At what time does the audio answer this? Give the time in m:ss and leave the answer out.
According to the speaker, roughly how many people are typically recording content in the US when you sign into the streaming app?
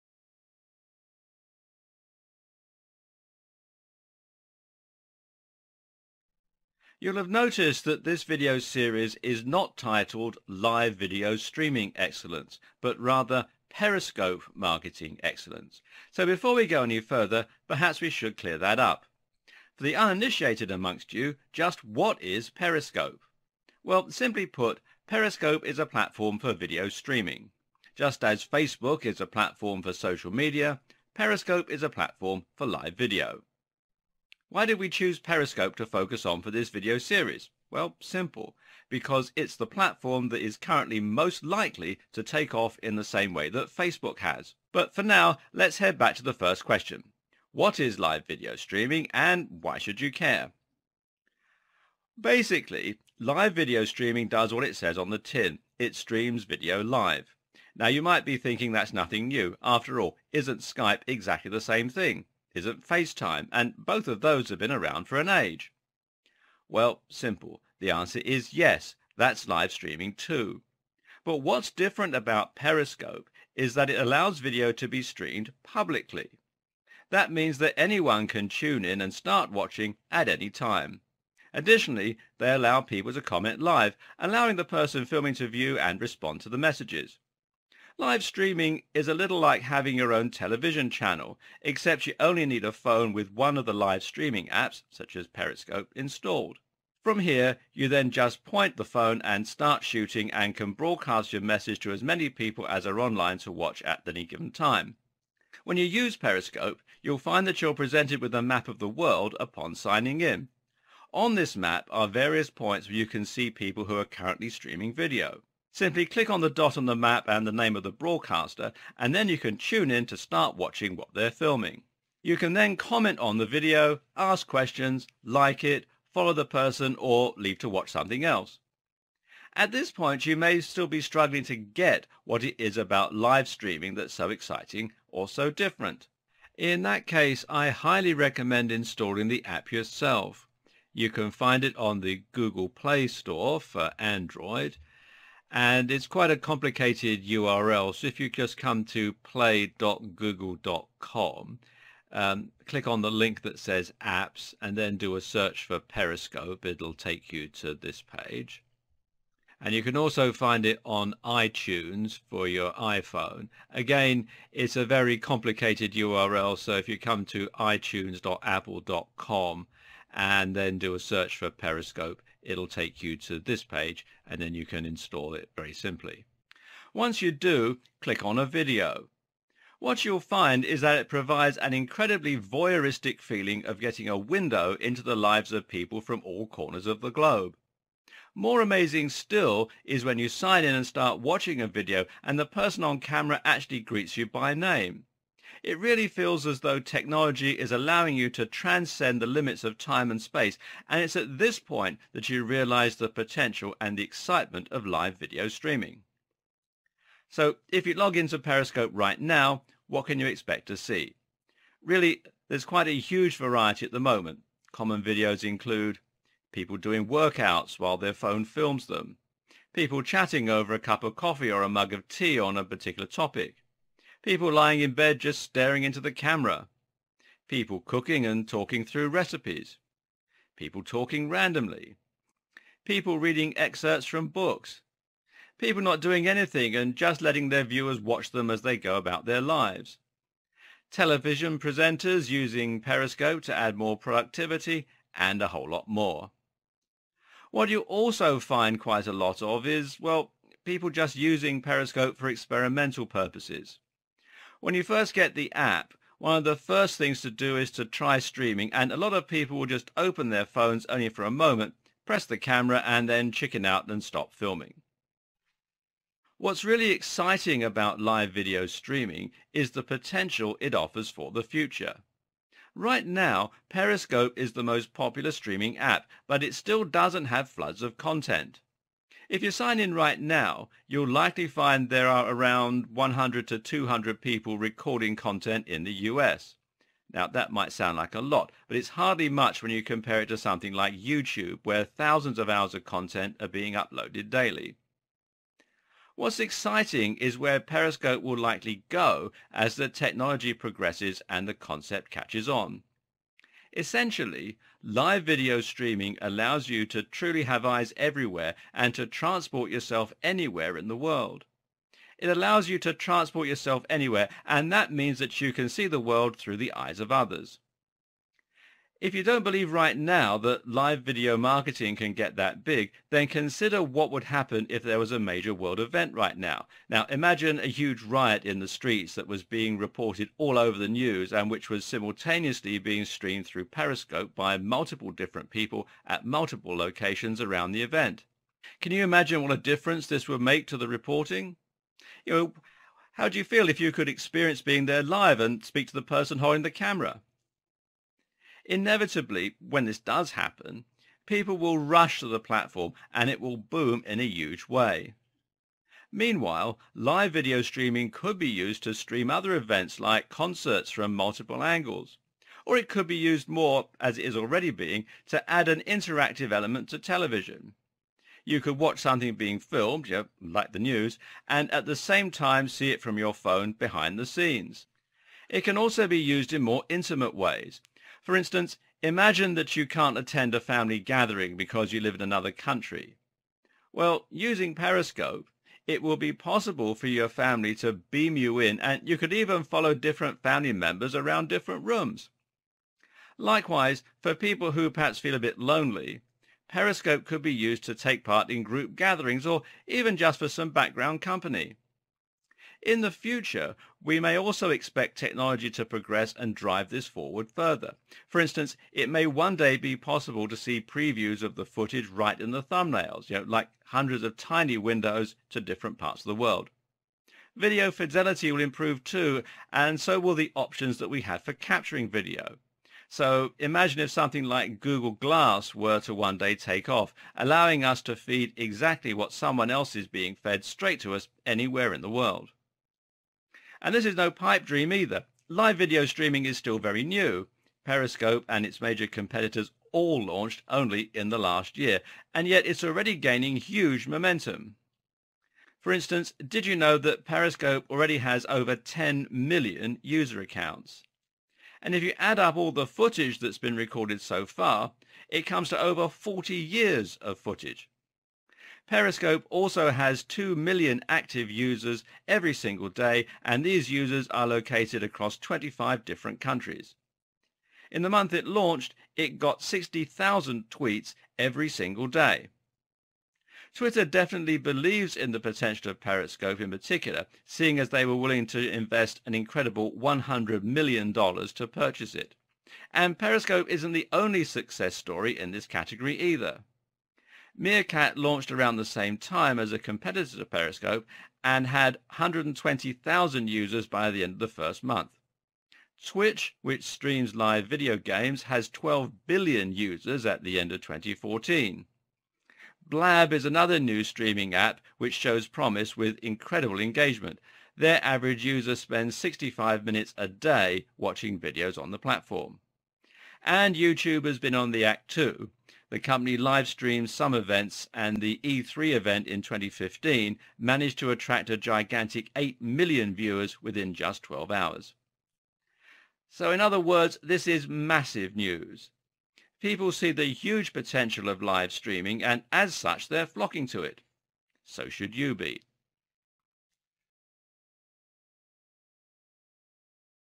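4:42.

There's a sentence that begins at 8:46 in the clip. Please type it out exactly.
So in other words, this is massive news.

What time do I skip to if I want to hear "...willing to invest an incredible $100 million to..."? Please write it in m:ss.
7:58.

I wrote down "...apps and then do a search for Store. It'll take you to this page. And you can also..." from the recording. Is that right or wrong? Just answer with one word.
wrong.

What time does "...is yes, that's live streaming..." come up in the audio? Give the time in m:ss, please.
1:08.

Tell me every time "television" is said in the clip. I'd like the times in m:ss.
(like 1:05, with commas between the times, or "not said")
1:30, 4:00, 6:06.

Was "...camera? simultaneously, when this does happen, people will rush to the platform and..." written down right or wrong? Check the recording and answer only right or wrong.
wrong.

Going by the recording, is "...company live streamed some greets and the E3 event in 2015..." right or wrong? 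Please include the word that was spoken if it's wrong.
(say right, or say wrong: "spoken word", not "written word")
wrong: "events", not "greets".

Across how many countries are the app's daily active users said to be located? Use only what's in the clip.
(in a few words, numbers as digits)
25.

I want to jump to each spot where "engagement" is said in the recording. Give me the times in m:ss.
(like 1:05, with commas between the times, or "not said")
8:26.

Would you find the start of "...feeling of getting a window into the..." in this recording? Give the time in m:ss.
3:03.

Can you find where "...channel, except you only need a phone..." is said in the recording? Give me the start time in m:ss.
1:30.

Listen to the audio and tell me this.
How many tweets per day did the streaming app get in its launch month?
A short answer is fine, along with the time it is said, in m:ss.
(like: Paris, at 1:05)
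60,000, at 7:49.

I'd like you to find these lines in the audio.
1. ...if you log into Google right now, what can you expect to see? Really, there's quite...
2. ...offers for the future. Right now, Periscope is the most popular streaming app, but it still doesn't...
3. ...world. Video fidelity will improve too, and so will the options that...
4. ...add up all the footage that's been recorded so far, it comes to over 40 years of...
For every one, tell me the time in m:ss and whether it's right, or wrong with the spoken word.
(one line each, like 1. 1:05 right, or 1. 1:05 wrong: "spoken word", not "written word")
1. 3:27 wrong: "Periscope", not "Google"
2. 4:30 right
3. 6:56 right
4. 7:32 right.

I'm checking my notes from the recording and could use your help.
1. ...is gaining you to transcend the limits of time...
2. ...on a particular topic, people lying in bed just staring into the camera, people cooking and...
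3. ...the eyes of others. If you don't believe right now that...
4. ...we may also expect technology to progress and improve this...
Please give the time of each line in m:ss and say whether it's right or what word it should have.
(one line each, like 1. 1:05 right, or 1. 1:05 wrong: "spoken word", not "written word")
1. 3:17 wrong: "allowing", not "gaining"
2. 3:42 right
3. 5:16 right
4. 6:44 wrong: "drive", not "improve".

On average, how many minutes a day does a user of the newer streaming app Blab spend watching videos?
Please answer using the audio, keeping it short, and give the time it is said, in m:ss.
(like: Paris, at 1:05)
65 minutes, at 8:29.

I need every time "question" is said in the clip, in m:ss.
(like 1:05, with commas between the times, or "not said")
0:46, 2:04.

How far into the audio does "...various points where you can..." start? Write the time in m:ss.
1:52.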